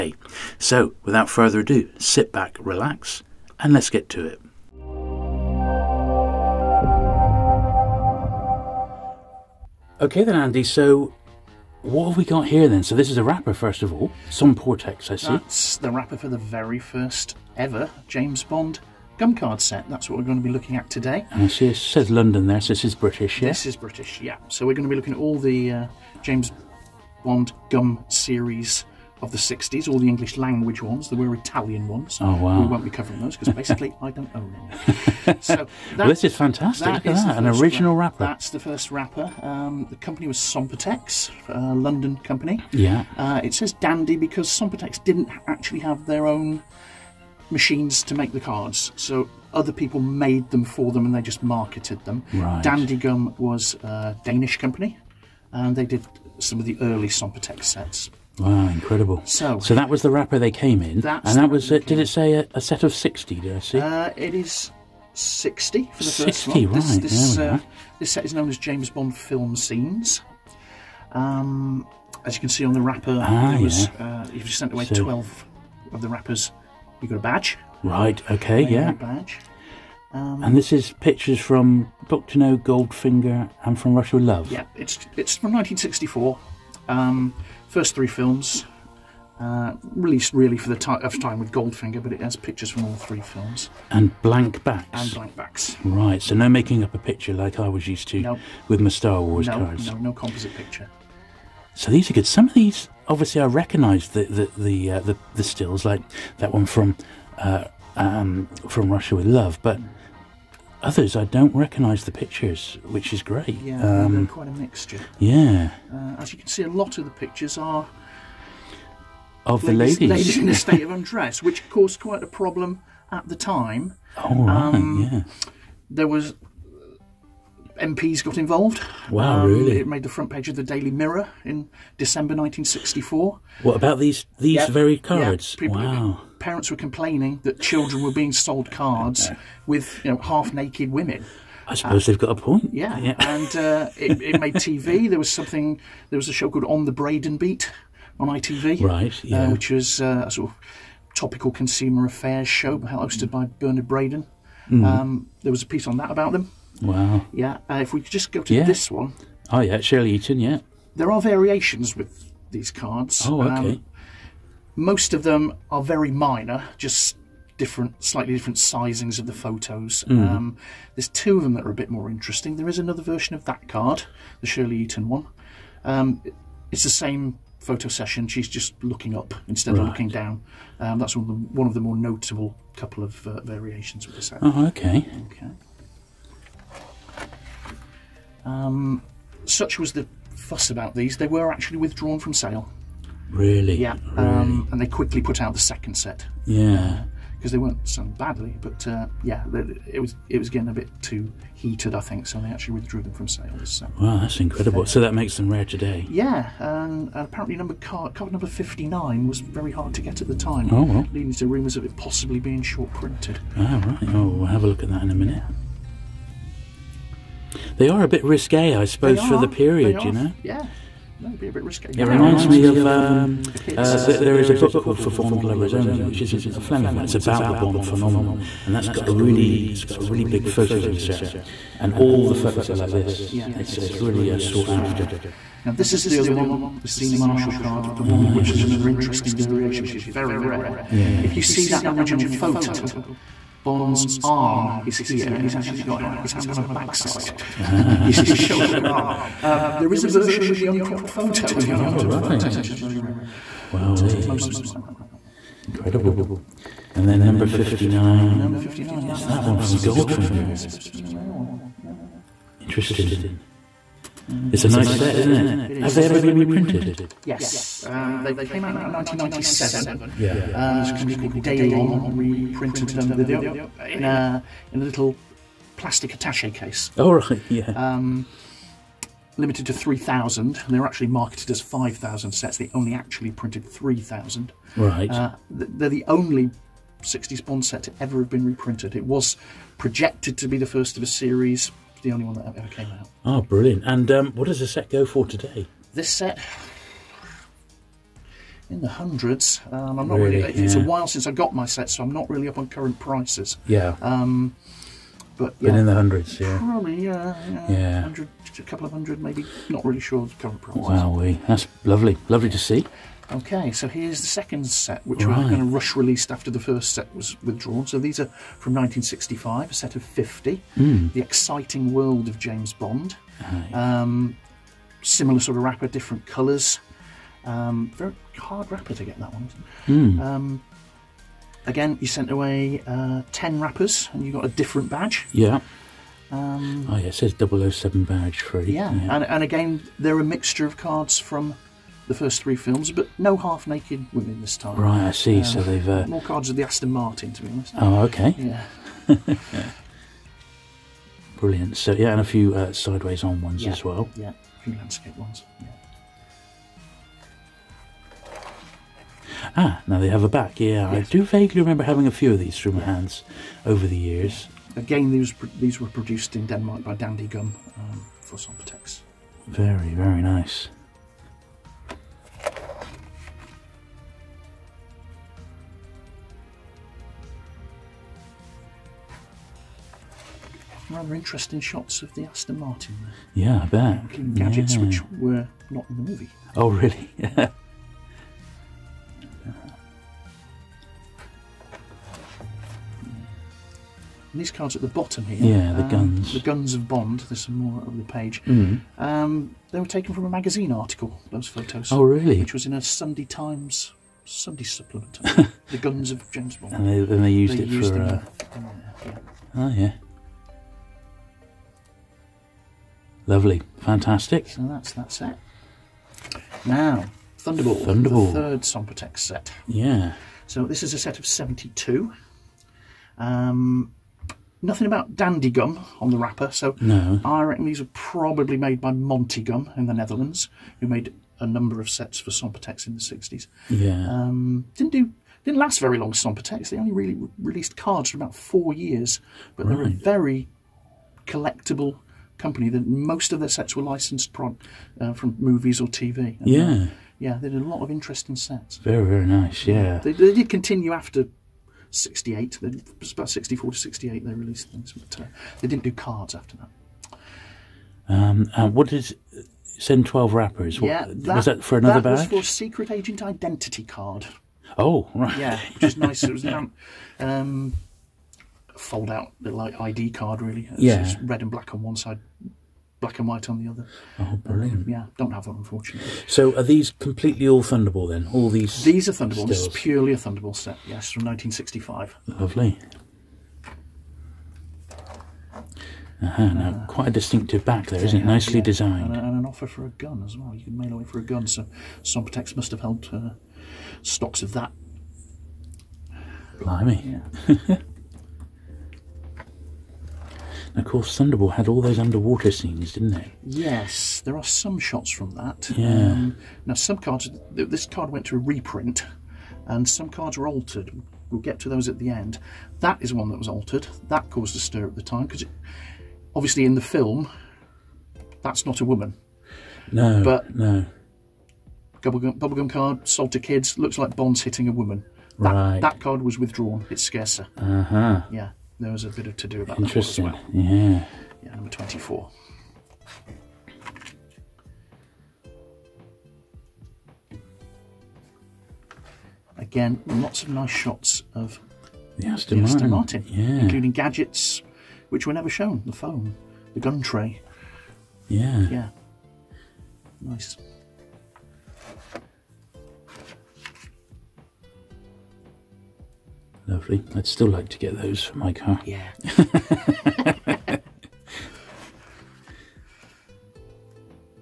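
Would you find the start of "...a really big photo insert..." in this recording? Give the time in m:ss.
3:49.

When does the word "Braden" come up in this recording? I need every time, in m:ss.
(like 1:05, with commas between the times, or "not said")
2:26, 2:33.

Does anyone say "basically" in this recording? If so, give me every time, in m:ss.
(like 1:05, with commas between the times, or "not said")
0:33.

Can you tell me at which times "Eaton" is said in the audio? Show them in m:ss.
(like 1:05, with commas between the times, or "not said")
2:40, 2:54.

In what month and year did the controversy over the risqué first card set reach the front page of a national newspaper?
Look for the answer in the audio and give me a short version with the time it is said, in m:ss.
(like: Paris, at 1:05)
December 1964, at 2:11.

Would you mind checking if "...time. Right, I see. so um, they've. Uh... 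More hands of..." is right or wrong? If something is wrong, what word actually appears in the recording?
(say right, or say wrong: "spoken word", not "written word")
wrong: "cards", not "hands".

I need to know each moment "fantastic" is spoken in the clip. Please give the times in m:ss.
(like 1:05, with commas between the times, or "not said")
0:36, 6:53.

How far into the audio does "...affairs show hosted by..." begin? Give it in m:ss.
2:32.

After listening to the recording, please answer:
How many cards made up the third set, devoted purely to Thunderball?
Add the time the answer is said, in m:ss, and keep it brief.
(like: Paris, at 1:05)
72, at 7:01.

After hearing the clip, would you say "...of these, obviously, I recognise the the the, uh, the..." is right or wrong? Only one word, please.
right.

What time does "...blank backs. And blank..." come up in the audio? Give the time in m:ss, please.
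1:34.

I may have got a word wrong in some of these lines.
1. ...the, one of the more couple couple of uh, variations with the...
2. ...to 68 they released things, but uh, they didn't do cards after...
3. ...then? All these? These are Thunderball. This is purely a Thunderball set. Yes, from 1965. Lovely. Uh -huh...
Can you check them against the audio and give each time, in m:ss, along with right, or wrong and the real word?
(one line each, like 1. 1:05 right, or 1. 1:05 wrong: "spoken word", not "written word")
1. 3:01 wrong: "notable", not "couple"
2. 7:33 right
3. 7:58 right.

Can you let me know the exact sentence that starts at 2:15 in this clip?
Yeah, wow parents were complaining that children were being sold cards with you know half naked women.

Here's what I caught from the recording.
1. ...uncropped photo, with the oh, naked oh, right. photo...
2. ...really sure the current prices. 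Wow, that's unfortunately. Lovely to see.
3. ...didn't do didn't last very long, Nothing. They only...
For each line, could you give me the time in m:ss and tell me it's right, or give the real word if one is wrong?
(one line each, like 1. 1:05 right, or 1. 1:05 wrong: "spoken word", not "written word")
1. 4:10 wrong: "unaltered", not "naked"
2. 5:09 wrong: "lovely", not "unfortunately"
3. 7:14 wrong: "Somportex", not "Nothing".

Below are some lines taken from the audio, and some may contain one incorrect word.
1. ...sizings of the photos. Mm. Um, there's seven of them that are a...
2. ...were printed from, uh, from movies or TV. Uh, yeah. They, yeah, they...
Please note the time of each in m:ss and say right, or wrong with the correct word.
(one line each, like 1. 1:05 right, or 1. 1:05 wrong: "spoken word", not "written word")
1. 2:48 wrong: "two", not "seven"
2. 7:23 wrong: "licensed", not "printed".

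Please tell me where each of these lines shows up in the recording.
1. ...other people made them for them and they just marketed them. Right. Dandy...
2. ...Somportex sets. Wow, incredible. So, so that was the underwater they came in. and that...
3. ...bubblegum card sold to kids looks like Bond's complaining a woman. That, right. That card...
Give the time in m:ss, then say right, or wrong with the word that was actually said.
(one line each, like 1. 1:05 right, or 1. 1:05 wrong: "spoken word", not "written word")
1. 0:49 right
2. 0:57 wrong: "wrapper", not "underwater"
3. 8:42 wrong: "hitting", not "complaining".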